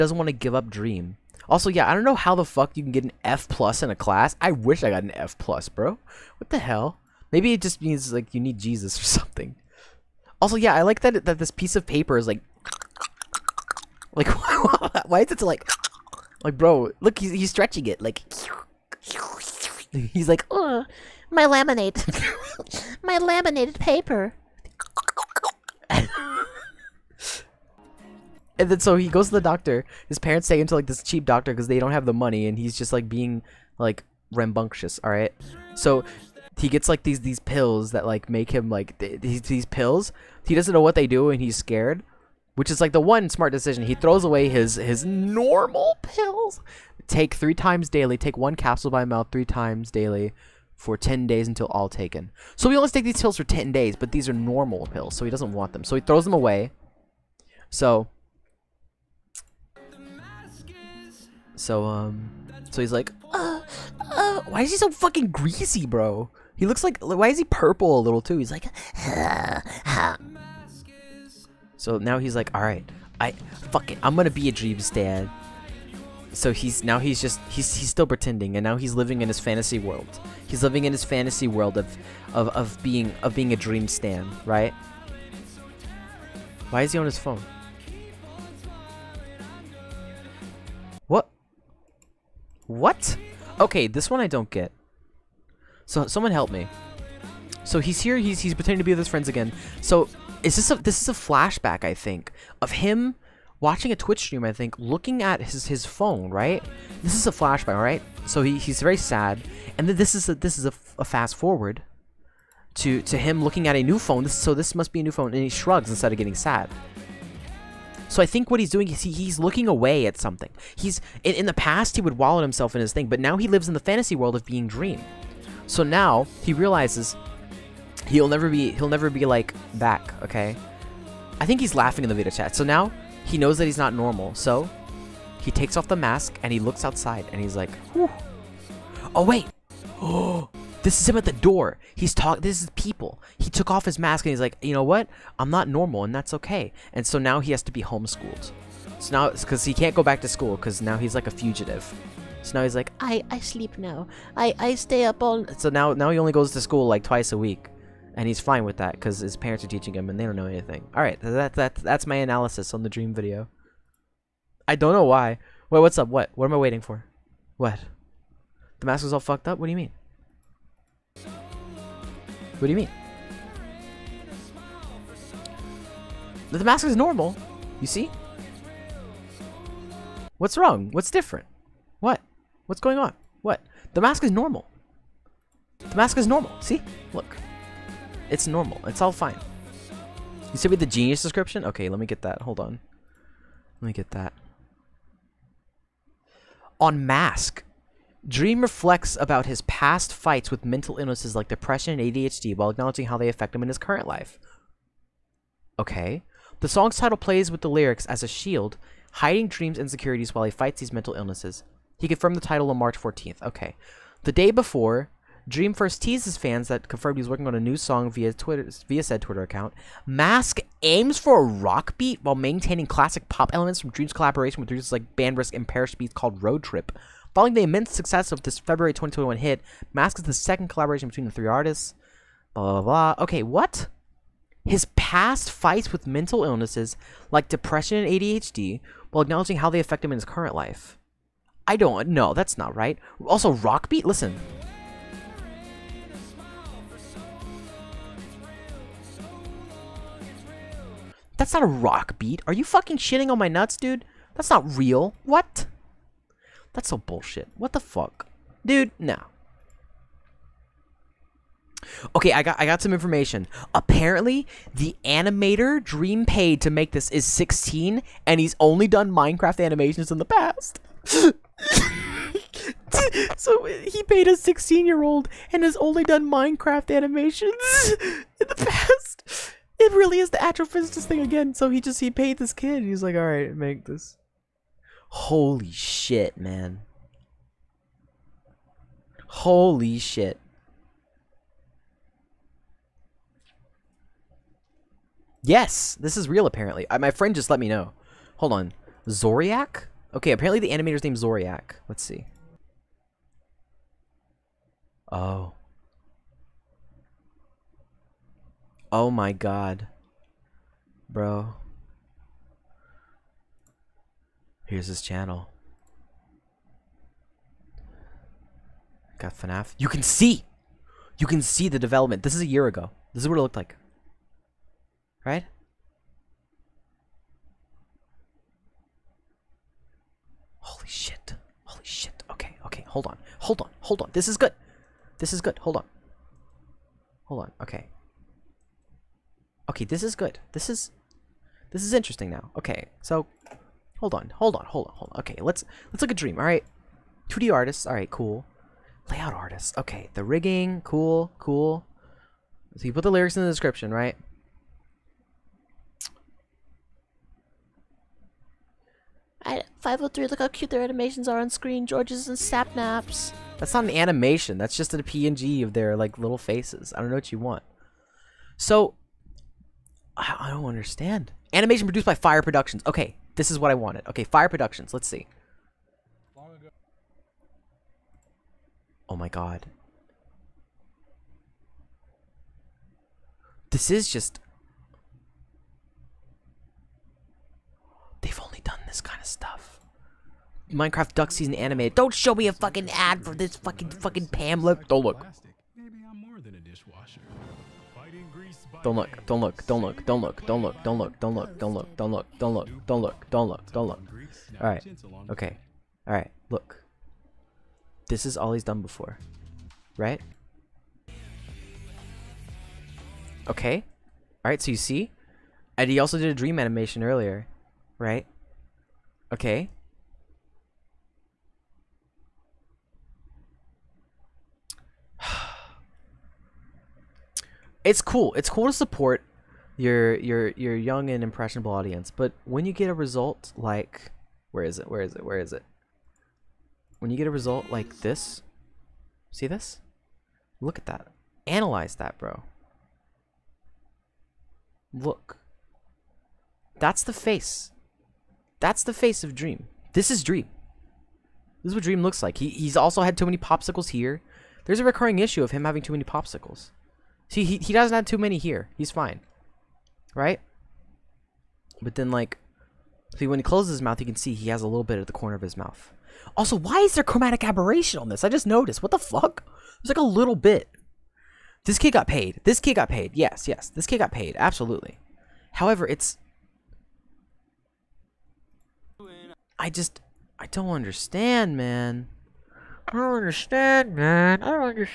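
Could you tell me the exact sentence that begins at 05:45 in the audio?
Okay, let's let's look at Dream.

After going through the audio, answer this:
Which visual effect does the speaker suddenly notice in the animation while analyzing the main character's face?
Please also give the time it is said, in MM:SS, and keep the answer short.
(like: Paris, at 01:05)
chromatic aberration, at 07:47.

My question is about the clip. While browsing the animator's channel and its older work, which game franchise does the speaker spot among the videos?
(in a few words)
FNAF.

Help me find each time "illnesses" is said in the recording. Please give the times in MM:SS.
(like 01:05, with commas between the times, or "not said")
03:20, 03:31, 03:56.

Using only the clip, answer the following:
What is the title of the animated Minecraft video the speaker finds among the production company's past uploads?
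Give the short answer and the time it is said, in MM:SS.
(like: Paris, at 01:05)
Minecraft Duck Season Animated, at 06:30.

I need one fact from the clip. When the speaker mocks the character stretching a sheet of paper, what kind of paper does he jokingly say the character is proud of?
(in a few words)
laminated paper.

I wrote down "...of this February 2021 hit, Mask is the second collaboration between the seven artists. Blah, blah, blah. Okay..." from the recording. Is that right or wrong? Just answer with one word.
wrong.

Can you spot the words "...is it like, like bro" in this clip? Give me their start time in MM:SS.
00:15.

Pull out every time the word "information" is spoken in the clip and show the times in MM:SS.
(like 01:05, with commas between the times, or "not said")
04:22.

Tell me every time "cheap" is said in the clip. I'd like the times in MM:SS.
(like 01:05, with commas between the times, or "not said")
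00:31.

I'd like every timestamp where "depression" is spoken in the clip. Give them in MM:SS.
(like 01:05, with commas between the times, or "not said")
03:21, 03:57.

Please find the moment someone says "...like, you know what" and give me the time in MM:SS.
02:24.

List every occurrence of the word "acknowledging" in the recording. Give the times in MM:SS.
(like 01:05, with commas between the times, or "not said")
03:22, 03:59.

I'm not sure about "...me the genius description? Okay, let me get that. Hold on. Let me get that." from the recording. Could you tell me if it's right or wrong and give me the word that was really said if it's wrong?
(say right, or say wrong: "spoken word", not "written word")
right.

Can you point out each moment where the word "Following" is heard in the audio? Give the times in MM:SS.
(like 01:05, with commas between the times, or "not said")
03:47.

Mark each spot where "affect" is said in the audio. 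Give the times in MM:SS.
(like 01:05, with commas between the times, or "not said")
03:23, 03:59.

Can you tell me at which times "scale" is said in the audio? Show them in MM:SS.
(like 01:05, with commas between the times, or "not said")
not said.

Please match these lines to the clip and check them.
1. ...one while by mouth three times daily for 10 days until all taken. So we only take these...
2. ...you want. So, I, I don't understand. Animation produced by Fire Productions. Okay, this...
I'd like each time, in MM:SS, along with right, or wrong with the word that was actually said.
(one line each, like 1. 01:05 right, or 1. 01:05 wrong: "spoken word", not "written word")
1. 00:48 wrong: "capsule", not "while"
2. 06:07 right.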